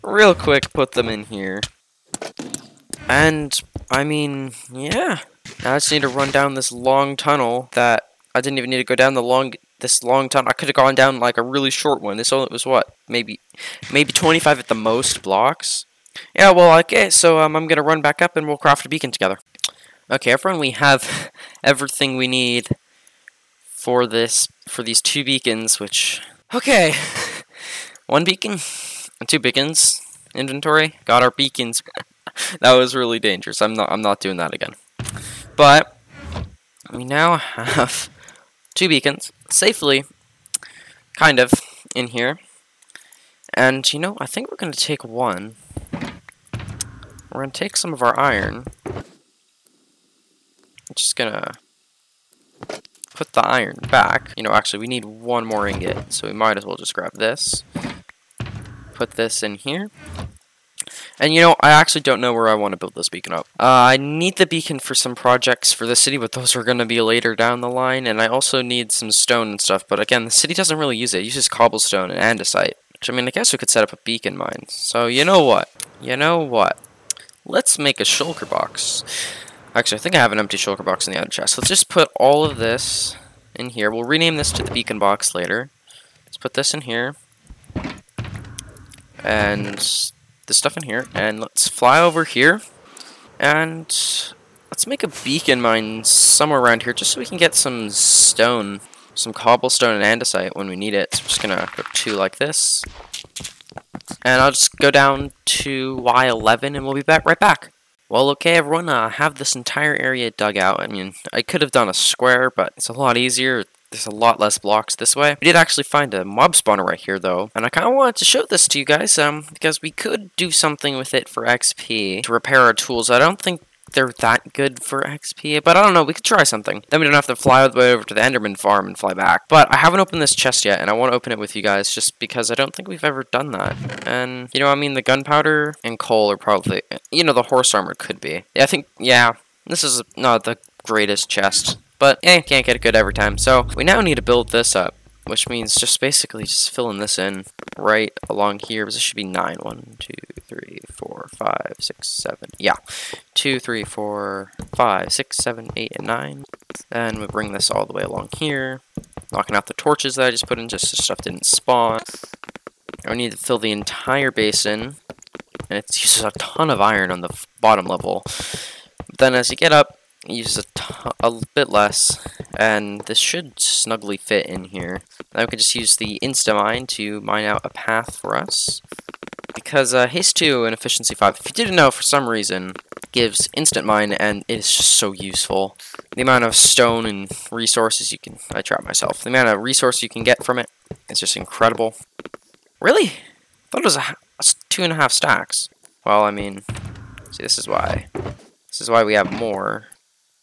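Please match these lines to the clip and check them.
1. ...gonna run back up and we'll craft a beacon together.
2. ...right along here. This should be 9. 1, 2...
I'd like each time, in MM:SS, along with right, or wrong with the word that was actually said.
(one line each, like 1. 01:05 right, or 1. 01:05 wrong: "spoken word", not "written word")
1. 00:17 right
2. 02:27 right.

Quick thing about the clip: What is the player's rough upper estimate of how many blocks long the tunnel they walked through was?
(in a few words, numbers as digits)
25.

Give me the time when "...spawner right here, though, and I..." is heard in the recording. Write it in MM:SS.
01:56.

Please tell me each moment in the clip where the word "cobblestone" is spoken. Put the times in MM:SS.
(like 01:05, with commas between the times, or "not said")
01:11, 01:39.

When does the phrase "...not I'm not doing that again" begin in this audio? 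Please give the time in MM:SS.
00:33.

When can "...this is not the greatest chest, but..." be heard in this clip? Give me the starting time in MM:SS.
02:19.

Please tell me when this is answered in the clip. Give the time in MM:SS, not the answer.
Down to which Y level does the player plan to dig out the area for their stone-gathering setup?
01:45.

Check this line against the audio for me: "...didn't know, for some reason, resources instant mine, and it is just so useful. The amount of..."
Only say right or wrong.
wrong.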